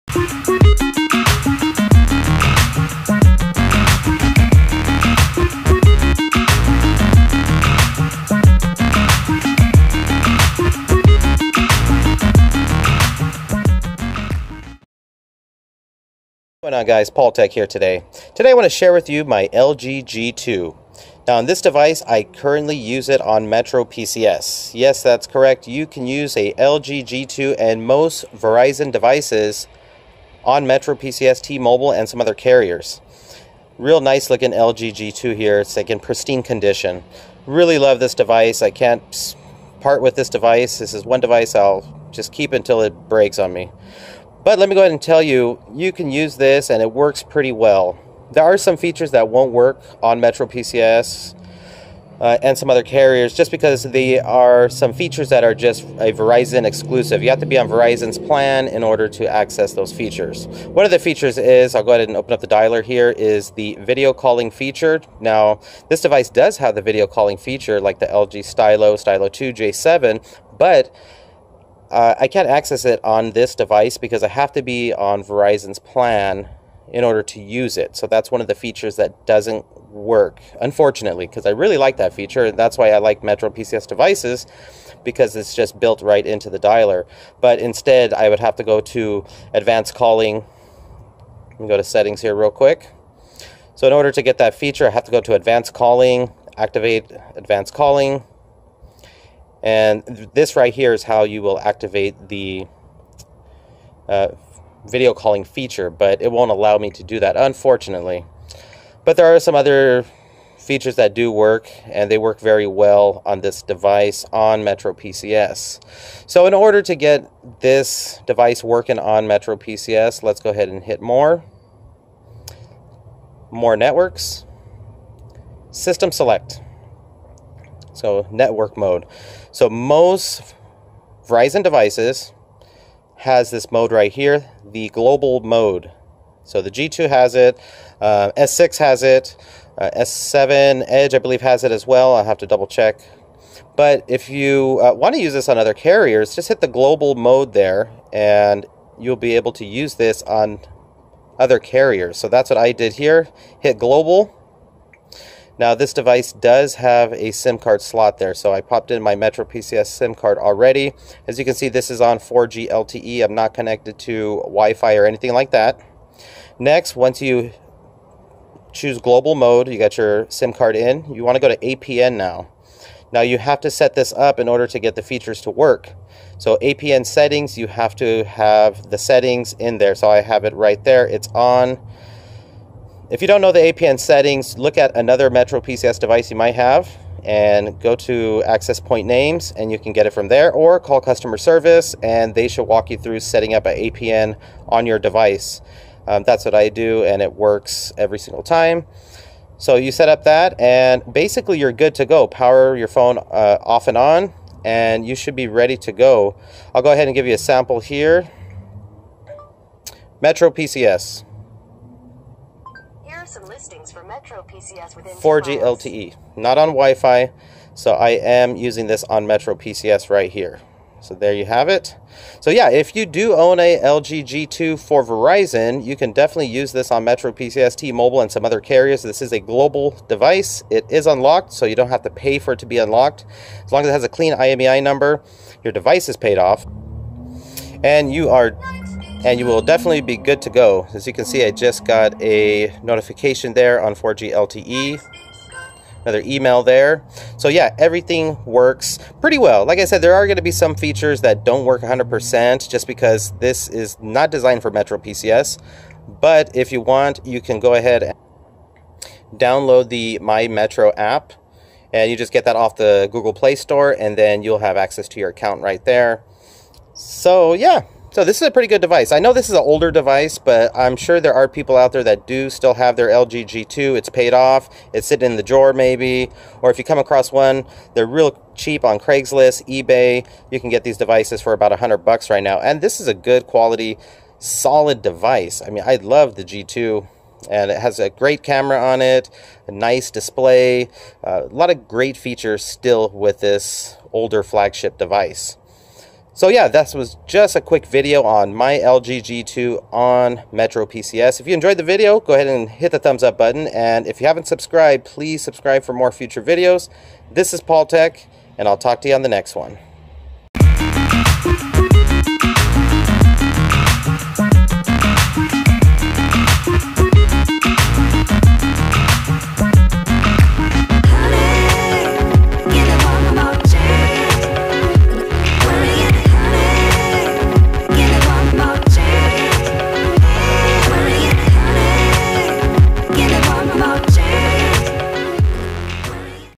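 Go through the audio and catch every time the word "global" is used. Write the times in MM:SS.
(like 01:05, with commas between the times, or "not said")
02:14, 02:26, 02:33, 02:48, 03:49.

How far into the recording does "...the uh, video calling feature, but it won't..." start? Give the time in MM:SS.
01:42.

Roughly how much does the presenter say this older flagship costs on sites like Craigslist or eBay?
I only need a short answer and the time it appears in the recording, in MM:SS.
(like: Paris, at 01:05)
$100, at 04:41.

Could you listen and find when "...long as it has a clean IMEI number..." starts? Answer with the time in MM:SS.
03:53.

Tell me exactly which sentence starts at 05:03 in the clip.
And if you haven't subscribed, please subscribe for more future videos.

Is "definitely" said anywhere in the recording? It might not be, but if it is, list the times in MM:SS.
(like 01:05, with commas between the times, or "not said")
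03:46, 03:59.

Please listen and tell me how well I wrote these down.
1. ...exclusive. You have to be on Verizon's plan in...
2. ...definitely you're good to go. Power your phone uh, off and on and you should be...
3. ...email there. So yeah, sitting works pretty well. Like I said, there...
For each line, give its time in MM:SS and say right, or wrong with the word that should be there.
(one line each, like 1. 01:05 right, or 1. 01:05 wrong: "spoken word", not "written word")
1. 00:56 right
2. 03:21 wrong: "basically", not "definitely"
3. 04:06 wrong: "everything", not "sitting".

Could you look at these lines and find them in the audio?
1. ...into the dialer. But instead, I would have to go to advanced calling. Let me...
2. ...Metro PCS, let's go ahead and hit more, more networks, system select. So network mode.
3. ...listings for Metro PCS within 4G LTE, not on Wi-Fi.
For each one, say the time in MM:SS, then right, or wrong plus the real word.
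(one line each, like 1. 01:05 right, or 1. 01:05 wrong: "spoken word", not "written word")
1. 01:26 right
2. 01:59 right
3. 03:33 right.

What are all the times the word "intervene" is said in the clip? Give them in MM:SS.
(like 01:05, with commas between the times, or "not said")
not said.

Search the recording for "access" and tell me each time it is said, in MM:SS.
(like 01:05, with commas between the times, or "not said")
00:59, 01:12, 03:08, 04:24.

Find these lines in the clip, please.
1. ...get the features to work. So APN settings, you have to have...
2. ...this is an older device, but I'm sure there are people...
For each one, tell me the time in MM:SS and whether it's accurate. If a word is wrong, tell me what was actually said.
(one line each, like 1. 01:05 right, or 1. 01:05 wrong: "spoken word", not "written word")
1. 02:54 right
2. 04:29 right.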